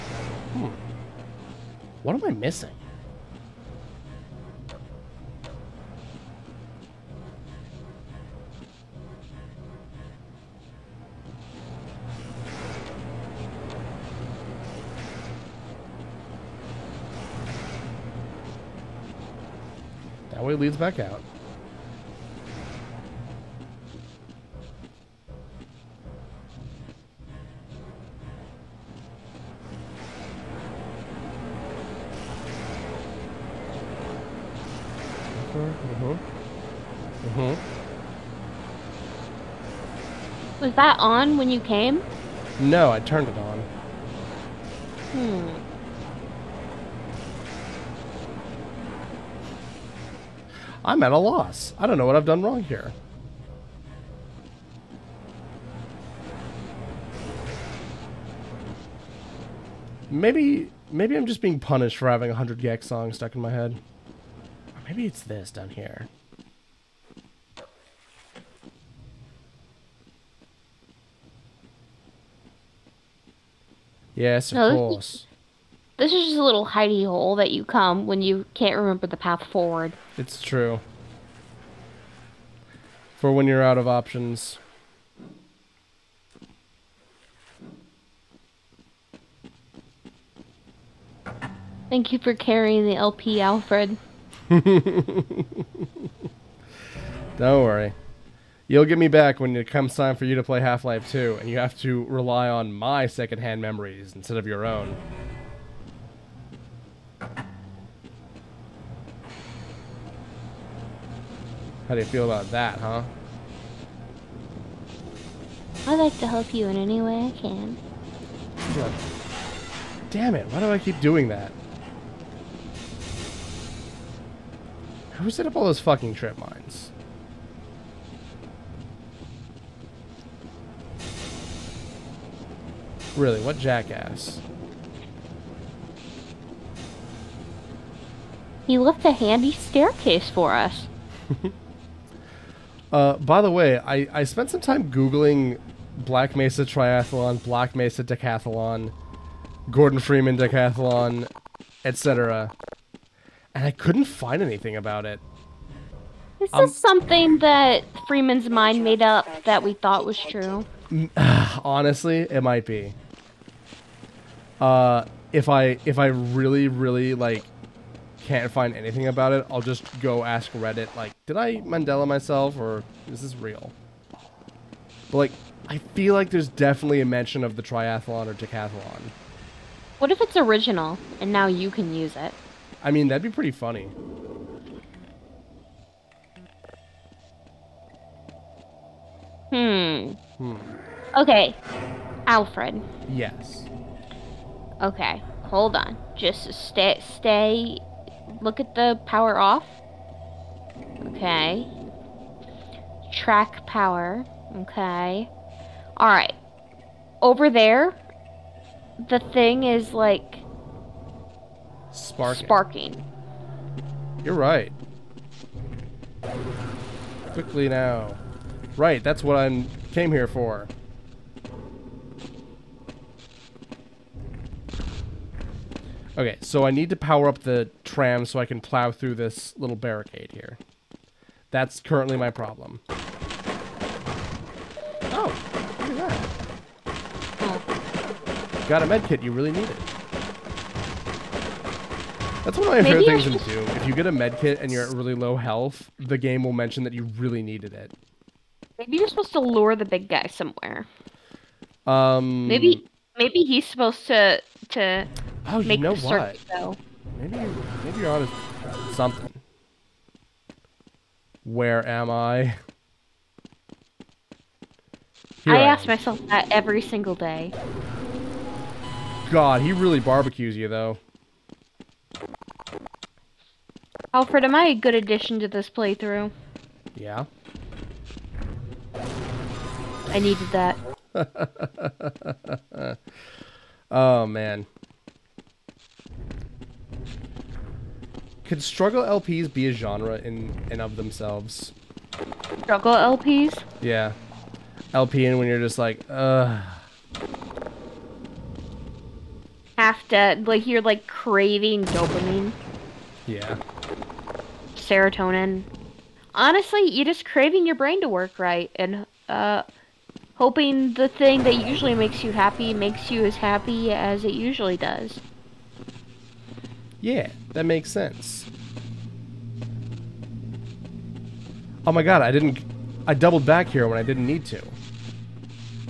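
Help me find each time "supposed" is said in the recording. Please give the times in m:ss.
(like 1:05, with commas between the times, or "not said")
4:09, 4:13.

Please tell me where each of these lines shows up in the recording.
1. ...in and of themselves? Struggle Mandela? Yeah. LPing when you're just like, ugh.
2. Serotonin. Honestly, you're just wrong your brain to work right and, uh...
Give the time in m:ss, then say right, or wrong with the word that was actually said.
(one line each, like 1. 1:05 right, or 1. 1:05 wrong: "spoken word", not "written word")
1. 4:50 wrong: "LPs", not "Mandela"
2. 5:04 wrong: "craving", not "wrong".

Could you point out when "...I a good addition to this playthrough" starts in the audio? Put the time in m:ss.
4:34.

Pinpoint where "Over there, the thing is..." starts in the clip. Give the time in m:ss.
3:27.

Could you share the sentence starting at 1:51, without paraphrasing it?
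How do you feel about that, huh?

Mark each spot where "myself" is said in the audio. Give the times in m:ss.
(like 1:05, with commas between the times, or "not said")
2:52, 4:25.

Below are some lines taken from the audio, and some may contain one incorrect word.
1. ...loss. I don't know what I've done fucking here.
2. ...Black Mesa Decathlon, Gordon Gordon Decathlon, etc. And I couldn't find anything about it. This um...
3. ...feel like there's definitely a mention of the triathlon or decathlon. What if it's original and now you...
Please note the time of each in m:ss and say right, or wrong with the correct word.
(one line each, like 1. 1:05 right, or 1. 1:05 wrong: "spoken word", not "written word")
1. 0:51 wrong: "wrong", not "fucking"
2. 2:27 wrong: "Freeman", not "Gordon"
3. 2:55 right.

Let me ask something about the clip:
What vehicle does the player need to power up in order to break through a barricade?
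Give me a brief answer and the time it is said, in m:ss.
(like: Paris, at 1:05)
tram, at 3:47.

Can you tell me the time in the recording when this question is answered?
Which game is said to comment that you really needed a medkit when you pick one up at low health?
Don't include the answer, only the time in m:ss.
4:03.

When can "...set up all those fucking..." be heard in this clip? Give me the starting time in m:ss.
2:05.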